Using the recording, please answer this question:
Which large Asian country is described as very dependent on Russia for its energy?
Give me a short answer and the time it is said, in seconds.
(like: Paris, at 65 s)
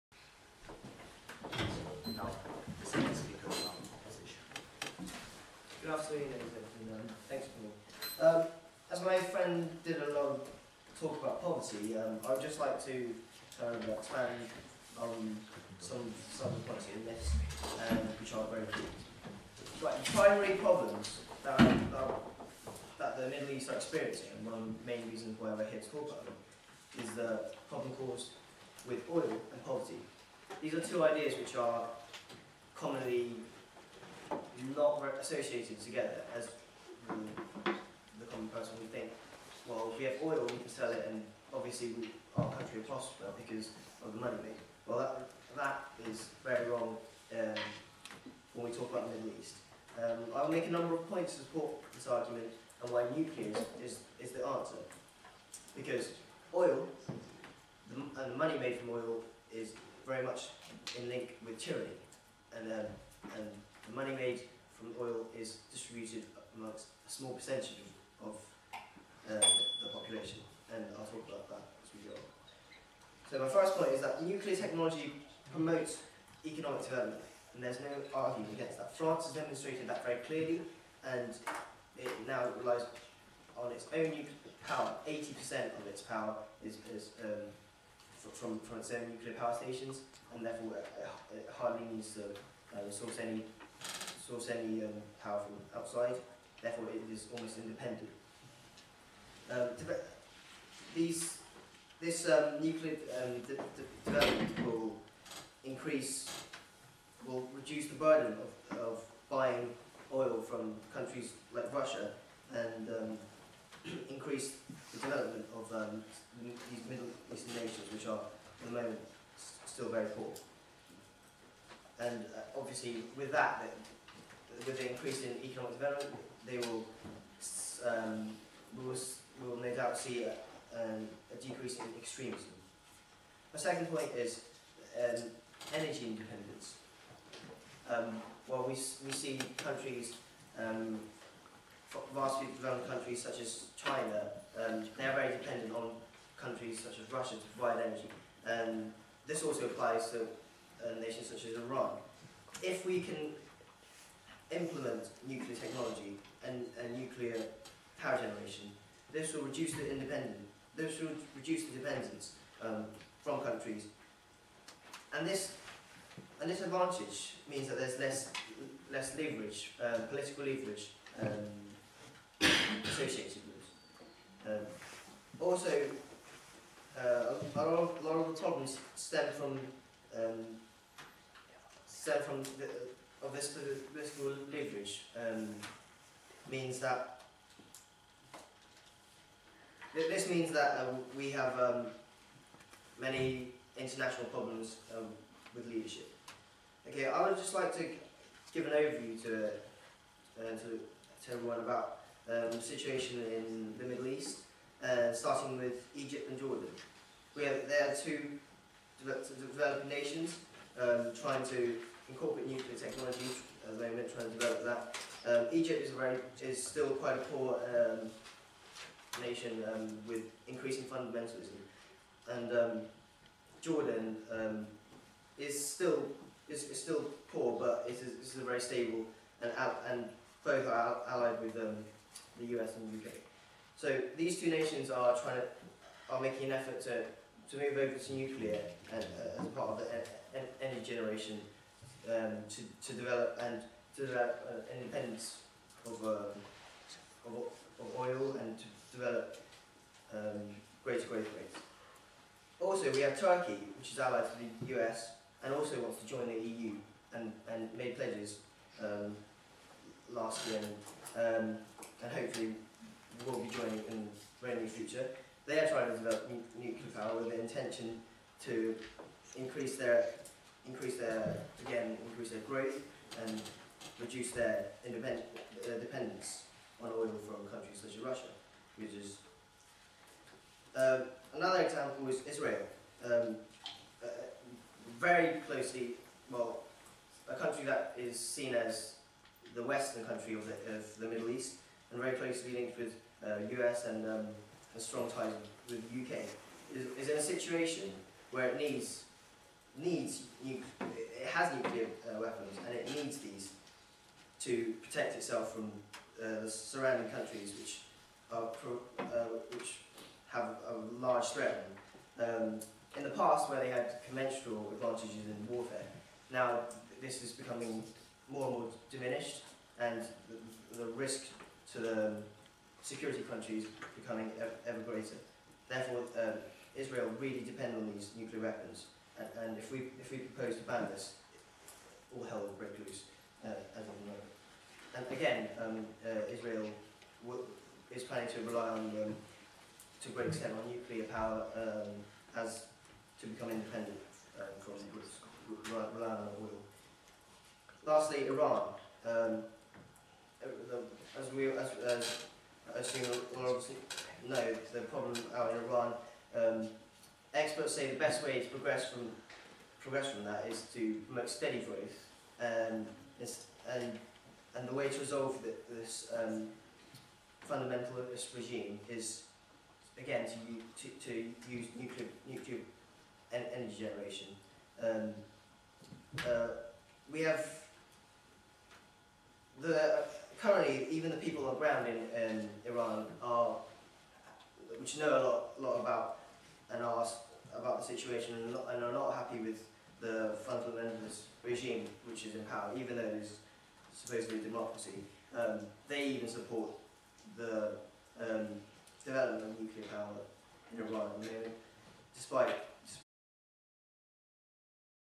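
China, at 143 s.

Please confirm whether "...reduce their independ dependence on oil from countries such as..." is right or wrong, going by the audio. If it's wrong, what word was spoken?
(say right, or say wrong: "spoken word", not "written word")
right.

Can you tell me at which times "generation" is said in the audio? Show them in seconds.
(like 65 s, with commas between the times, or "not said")
158 s, 240 s, 373 s.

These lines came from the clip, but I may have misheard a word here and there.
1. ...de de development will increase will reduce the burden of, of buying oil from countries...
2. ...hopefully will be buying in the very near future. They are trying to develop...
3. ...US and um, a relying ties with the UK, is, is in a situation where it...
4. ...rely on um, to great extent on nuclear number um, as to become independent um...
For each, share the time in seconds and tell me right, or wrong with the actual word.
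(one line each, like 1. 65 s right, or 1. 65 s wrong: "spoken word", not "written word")
1. 103 s right
2. 262 s wrong: "joining", not "buying"
3. 293 s wrong: "strong", not "relying"
4. 338 s wrong: "power", not "number".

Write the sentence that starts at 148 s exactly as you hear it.
And um, this also applies to a nation such as Iran.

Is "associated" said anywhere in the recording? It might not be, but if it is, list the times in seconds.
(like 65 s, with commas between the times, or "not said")
35 s, 172 s.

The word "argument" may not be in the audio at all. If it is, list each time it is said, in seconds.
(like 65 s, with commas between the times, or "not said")
52 s, 78 s.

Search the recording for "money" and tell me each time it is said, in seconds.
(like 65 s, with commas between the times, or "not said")
44 s, 58 s, 64 s.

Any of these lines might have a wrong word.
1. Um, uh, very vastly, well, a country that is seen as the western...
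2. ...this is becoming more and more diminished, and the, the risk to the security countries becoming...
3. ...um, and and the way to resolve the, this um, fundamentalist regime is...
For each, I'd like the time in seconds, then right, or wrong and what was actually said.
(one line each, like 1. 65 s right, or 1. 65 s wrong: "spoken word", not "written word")
1. 283 s wrong: "closely", not "vastly"
2. 317 s right
3. 362 s right.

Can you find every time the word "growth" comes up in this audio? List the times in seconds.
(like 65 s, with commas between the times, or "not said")
251 s, 272 s, 361 s.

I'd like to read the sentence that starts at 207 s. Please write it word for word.
We have, they are two developed, developed nations um, trying to incorporate nuclear technologies at the moment, trying to develop that.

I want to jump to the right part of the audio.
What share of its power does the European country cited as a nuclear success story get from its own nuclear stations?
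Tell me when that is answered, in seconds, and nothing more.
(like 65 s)
85 s.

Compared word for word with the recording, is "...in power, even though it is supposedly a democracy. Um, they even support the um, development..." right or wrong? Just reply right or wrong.
right.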